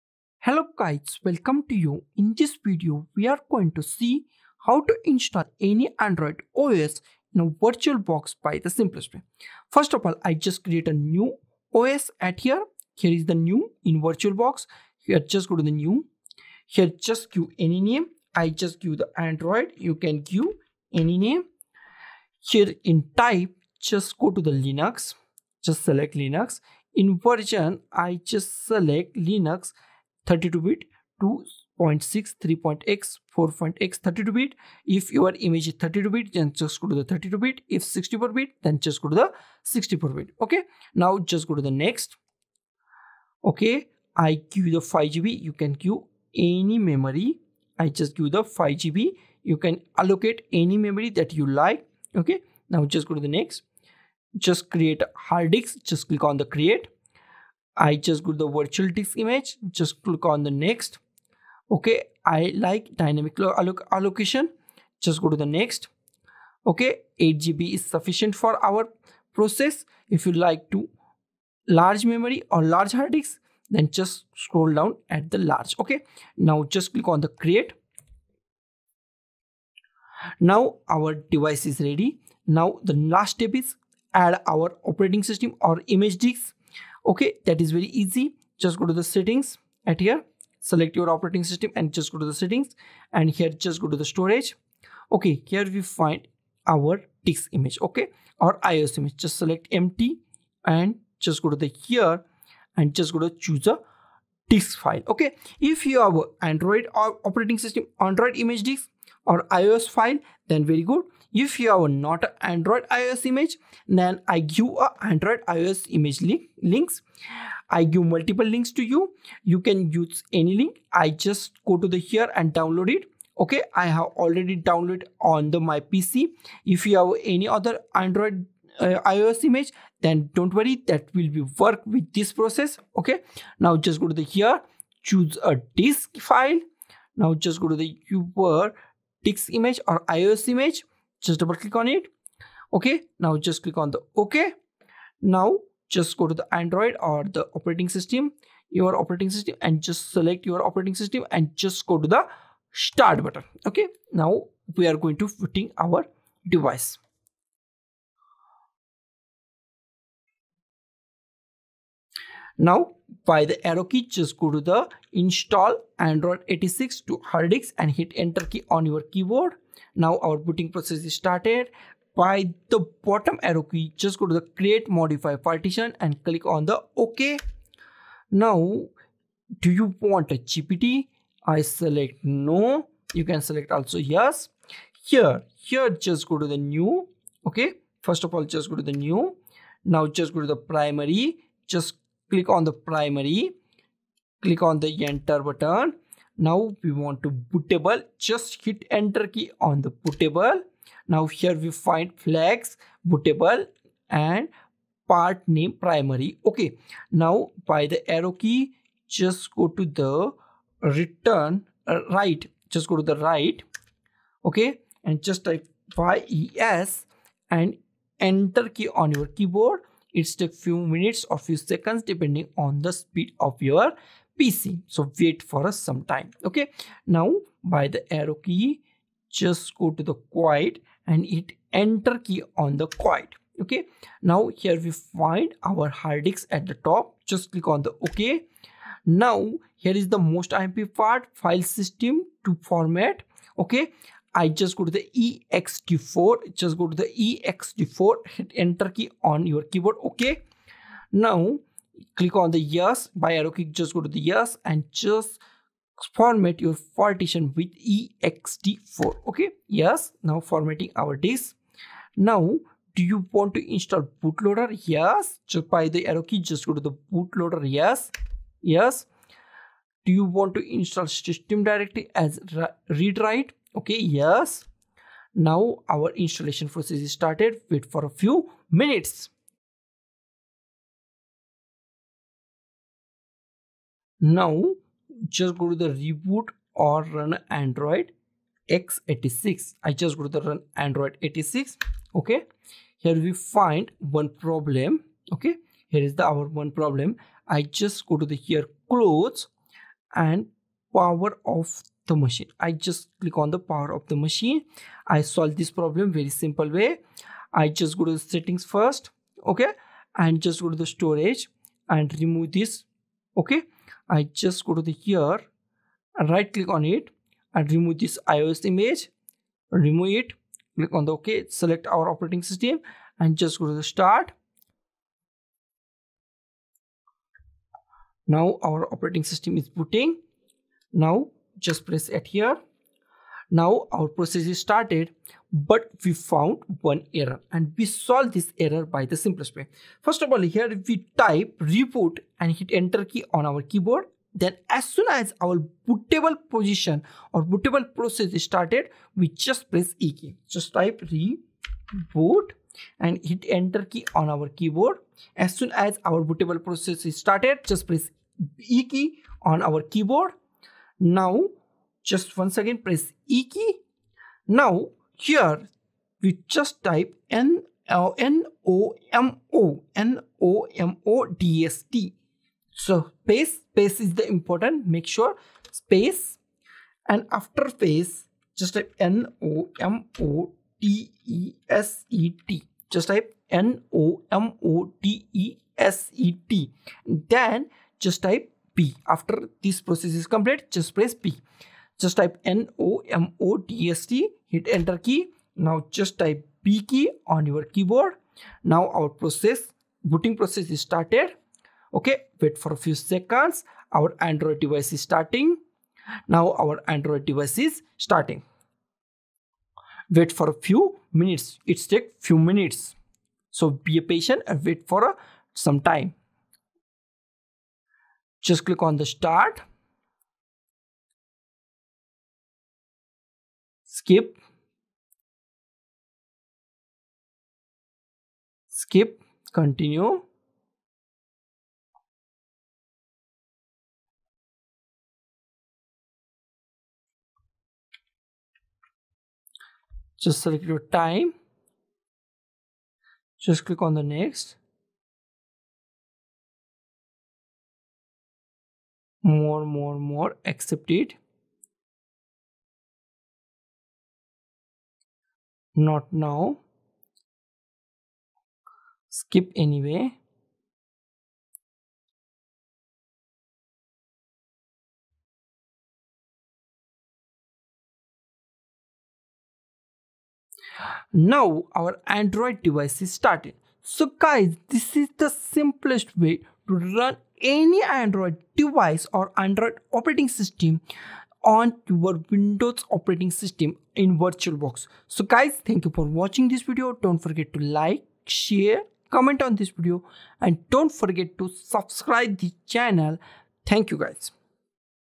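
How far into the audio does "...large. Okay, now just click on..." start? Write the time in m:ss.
1:15.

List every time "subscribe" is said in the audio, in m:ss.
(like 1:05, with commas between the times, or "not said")
8:11.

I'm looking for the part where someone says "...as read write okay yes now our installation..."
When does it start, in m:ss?
4:32.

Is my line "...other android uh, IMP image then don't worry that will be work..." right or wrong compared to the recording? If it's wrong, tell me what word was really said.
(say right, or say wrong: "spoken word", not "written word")
wrong: "ISO", not "IMP".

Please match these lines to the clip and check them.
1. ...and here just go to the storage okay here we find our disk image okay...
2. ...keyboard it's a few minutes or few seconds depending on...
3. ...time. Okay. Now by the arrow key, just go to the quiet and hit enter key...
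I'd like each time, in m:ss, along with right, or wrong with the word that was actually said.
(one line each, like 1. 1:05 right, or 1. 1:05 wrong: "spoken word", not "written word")
1. 1:33 right
2. 3:39 right
3. 3:46 right.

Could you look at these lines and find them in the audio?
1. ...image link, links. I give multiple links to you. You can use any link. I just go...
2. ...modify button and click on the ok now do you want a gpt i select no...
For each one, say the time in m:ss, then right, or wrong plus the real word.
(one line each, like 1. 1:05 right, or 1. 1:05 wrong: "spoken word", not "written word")
1. 1:55 right
2. 2:54 wrong: "partition", not "button".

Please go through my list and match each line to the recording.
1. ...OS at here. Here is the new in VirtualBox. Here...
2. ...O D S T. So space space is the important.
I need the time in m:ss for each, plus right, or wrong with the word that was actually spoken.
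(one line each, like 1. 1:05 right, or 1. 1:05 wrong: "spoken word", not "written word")
1. 0:11 right
2. 6:11 right.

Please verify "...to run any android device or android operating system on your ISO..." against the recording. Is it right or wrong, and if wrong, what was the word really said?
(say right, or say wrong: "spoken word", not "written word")
wrong: "Windows", not "ISO".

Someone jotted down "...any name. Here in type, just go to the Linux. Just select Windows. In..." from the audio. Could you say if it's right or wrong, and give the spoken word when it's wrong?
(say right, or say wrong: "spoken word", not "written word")
wrong: "Linux", not "Windows".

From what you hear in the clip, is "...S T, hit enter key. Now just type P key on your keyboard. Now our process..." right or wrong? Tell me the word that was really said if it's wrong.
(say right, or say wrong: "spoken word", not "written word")
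right.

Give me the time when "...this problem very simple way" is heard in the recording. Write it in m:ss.
5:05.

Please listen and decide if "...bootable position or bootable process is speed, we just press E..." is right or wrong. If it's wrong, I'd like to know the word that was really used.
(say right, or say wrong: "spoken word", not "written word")
wrong: "started", not "speed".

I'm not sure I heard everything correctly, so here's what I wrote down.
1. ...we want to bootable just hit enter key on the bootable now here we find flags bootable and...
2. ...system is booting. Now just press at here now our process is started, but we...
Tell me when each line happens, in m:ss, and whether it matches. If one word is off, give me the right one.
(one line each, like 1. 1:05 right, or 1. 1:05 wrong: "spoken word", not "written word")
1. 3:16 right
2. 5:29 right.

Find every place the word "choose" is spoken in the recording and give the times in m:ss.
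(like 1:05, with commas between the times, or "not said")
1:43, 2:15.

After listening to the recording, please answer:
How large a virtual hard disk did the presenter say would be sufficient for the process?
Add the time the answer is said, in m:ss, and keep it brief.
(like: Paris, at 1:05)
8 GB, at 1:07.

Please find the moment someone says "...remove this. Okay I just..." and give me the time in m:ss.
5:12.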